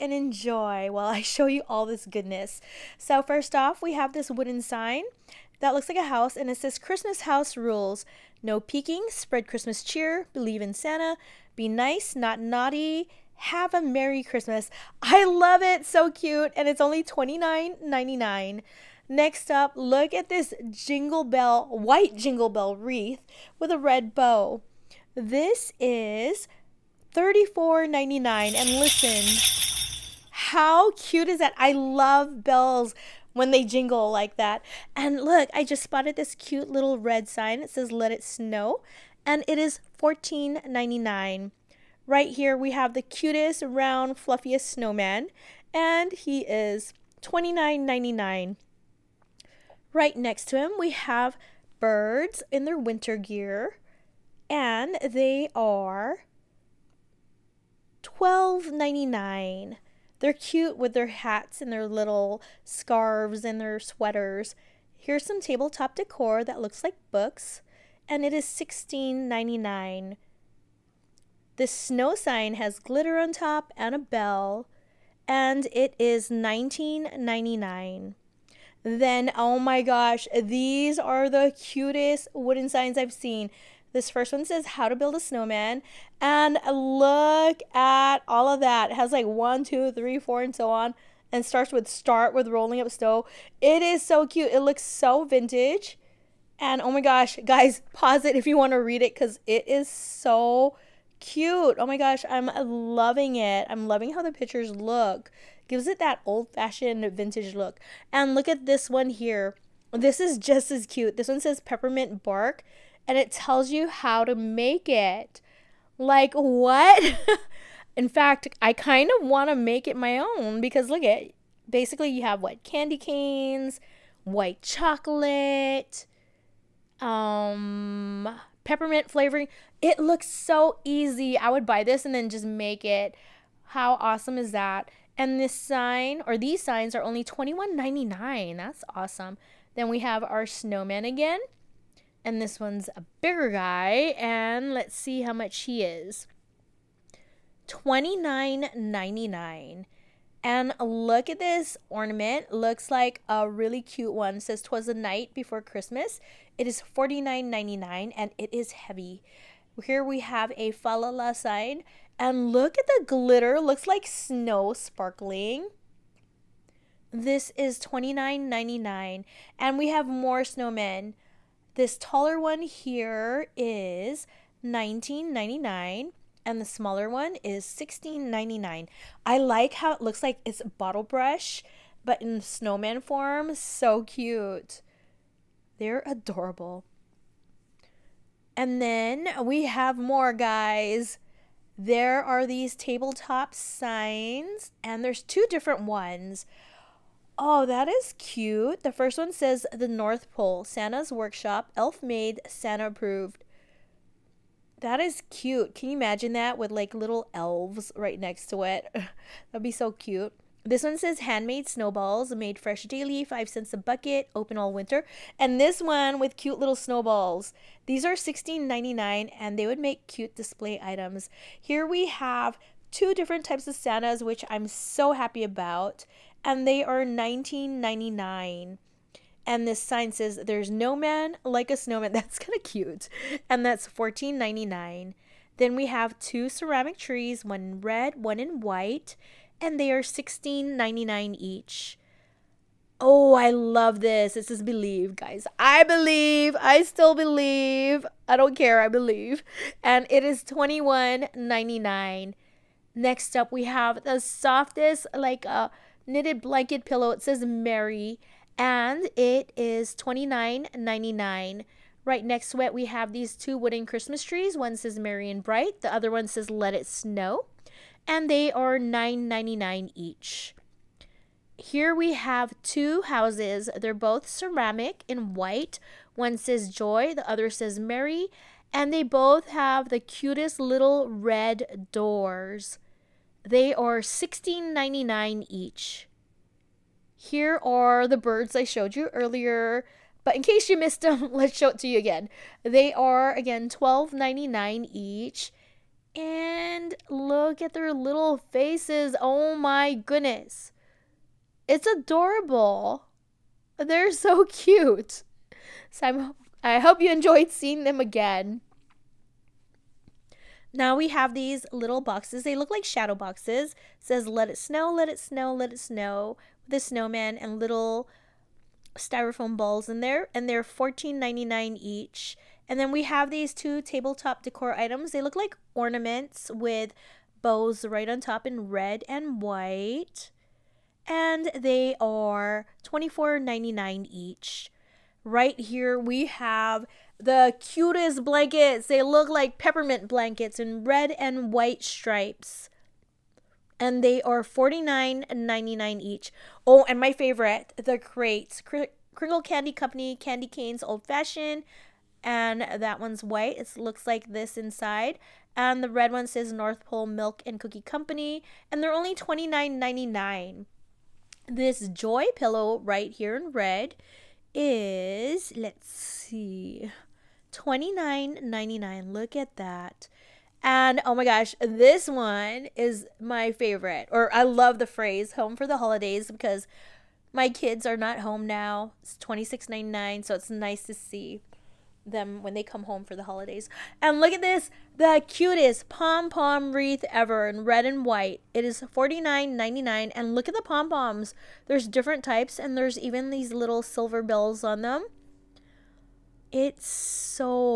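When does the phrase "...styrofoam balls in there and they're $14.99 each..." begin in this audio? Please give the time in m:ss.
5:18.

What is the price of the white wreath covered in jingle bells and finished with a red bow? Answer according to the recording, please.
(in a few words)
$34.99.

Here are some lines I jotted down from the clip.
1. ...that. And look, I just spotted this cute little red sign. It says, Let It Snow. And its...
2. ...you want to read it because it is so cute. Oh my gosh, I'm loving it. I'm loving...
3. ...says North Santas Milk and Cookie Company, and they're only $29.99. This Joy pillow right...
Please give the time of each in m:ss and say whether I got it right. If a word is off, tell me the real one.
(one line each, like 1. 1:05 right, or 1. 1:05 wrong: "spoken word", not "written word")
1. 0:34 right
2. 1:38 right
3. 5:56 wrong: "Pole", not "Santas".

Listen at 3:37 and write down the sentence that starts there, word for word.
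These are $16.99 and they would make cute display items.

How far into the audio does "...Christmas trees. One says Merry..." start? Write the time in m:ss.
4:23.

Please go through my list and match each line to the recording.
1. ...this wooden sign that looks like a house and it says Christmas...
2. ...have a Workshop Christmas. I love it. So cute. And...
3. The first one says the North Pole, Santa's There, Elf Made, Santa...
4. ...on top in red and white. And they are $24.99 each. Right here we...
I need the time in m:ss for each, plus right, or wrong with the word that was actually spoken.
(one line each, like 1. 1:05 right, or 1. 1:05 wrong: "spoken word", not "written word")
1. 0:04 right
2. 0:13 wrong: "Merry", not "Workshop"
3. 3:18 wrong: "Workshop", not "There"
4. 5:28 right.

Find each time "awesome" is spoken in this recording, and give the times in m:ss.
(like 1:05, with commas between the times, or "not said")
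2:13, 2:18.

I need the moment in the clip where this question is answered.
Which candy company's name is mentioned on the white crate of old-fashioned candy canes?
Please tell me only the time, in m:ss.
5:49.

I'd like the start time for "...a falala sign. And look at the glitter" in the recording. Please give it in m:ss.
2:40.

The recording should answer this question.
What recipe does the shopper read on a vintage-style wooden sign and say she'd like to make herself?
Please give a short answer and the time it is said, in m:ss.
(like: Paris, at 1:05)
Peppermint bark, at 1:51.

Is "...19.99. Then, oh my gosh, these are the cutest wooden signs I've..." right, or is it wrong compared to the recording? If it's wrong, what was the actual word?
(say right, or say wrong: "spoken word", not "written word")
right.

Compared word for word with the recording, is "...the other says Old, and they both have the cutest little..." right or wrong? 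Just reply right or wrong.
wrong.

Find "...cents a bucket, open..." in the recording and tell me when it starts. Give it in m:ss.
3:33.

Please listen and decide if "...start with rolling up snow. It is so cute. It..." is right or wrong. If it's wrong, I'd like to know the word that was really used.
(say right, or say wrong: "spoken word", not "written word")
right.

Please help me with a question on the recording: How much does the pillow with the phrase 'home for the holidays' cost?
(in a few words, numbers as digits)
$26.99.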